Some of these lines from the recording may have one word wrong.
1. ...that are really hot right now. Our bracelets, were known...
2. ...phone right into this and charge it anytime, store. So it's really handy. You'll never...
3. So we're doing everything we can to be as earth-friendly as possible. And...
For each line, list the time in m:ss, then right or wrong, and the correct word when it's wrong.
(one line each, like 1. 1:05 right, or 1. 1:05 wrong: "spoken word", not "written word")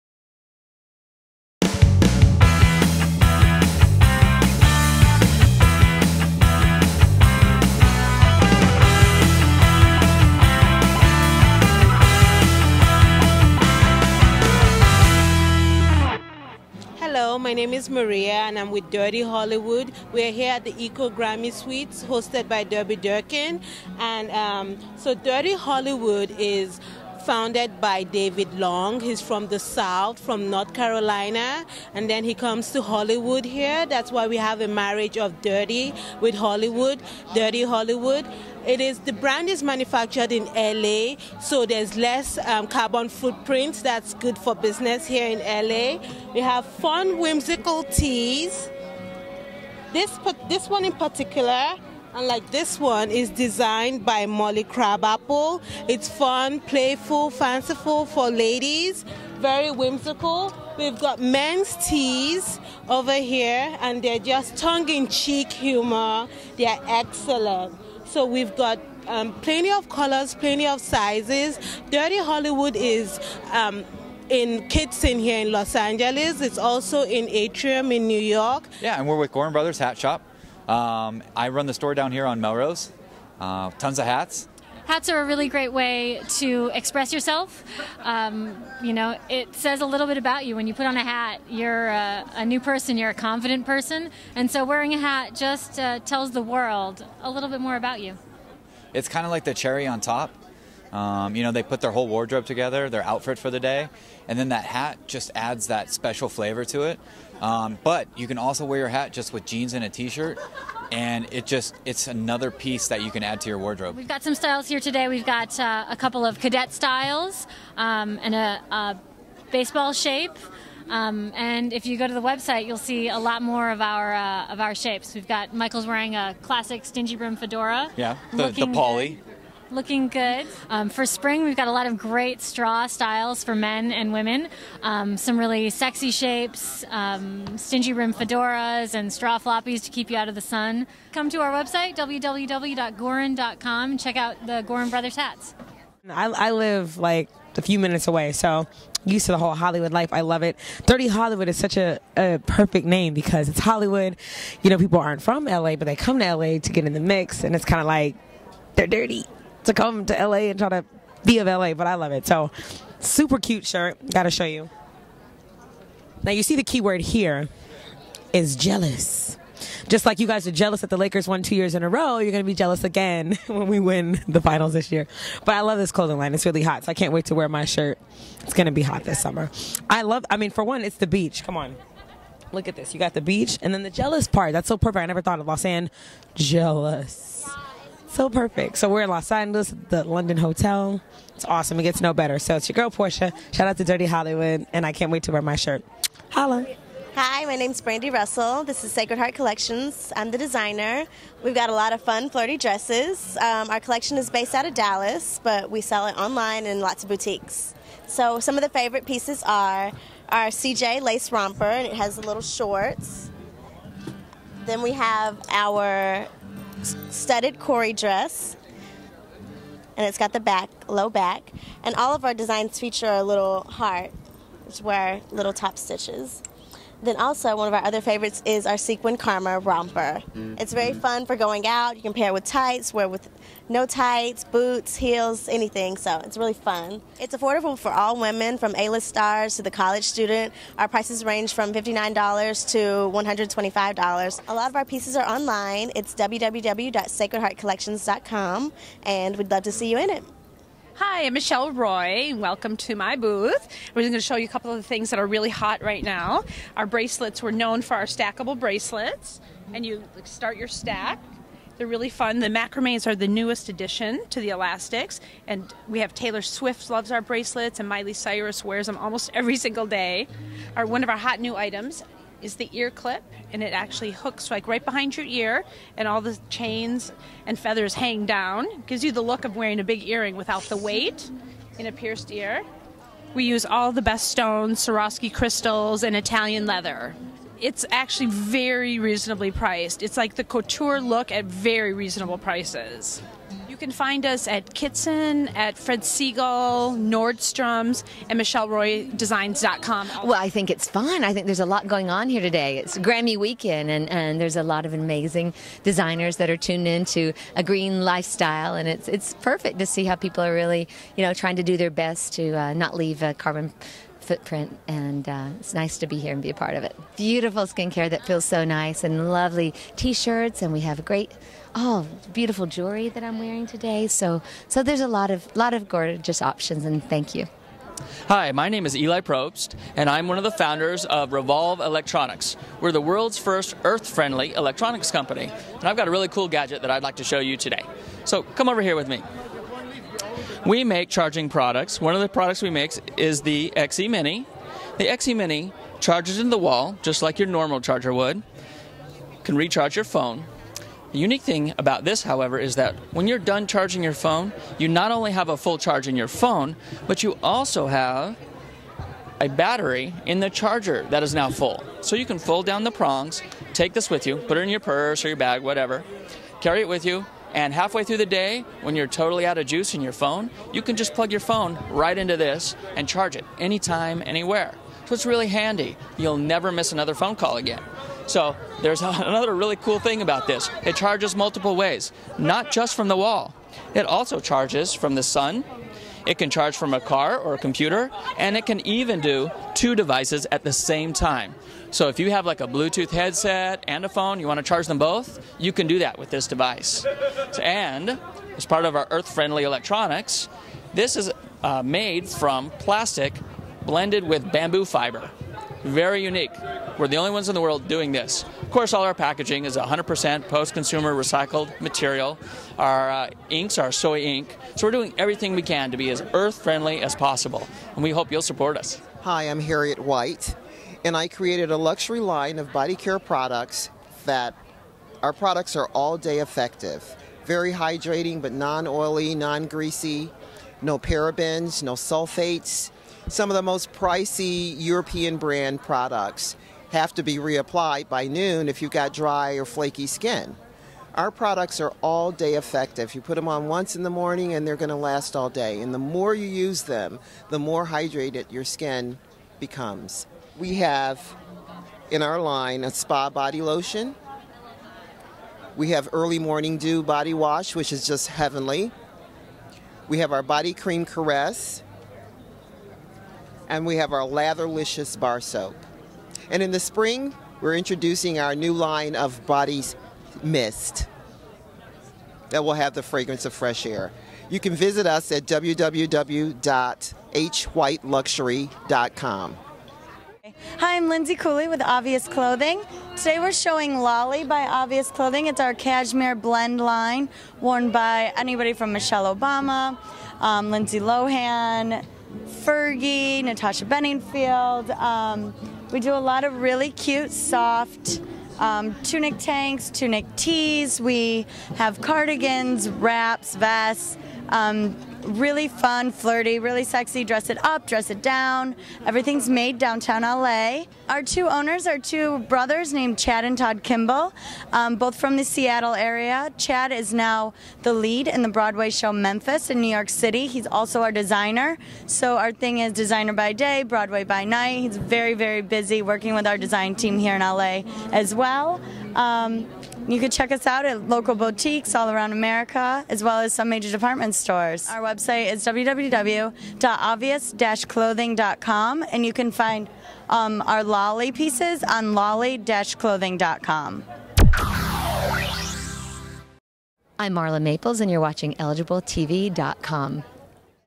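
1. 4:15 right
2. 6:11 wrong: "anywhere", not "store"
3. 6:54 right.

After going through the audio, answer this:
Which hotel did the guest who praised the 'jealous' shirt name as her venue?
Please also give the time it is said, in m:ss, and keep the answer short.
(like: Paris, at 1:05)
The London Hotel, at 3:09.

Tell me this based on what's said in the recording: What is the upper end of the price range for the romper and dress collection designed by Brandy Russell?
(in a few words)
$125.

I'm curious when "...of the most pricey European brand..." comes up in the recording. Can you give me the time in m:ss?
7:13.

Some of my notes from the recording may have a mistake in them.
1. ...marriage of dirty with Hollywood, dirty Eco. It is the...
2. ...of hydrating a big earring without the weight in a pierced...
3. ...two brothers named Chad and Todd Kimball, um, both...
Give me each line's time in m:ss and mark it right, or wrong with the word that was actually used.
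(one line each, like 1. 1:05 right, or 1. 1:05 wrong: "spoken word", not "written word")
1. 0:34 wrong: "Hollywood", not "Eco"
2. 4:39 wrong: "wearing", not "hydrating"
3. 8:31 right.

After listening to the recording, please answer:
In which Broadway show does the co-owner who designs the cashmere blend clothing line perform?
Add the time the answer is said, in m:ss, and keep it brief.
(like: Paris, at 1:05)
Memphis, at 8:39.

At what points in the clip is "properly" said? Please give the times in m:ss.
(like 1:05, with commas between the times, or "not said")
not said.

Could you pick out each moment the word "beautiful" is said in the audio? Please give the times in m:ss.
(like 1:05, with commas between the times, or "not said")
5:17, 5:22.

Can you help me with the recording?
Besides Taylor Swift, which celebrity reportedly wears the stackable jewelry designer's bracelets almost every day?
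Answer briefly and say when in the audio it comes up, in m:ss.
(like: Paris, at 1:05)
Miley Cyrus, at 4:27.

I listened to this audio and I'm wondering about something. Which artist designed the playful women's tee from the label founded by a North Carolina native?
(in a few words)
Molly Crabapple.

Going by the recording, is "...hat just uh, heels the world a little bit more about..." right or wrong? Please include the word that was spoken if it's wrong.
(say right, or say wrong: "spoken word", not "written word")
wrong: "tells", not "heels".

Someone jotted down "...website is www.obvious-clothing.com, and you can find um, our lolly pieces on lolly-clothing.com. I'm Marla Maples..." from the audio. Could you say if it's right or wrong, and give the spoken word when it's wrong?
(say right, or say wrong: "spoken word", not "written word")
right.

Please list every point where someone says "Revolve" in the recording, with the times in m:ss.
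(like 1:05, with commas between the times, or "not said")
5:31.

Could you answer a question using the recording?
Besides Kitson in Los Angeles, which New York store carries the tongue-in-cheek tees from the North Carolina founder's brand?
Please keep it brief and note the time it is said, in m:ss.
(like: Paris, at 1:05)
Atrium, at 1:17.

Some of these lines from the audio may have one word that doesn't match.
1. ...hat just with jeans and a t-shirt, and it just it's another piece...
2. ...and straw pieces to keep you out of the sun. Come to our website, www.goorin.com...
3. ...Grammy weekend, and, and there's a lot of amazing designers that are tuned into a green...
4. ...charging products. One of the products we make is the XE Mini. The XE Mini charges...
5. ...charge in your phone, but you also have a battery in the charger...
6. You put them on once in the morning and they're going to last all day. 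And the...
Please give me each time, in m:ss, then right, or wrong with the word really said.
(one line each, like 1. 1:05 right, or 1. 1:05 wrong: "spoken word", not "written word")
1. 1:48 right
2. 2:18 wrong: "floppies", not "pieces"
3. 5:02 right
4. 5:41 right
5. 5:55 right
6. 7:23 right.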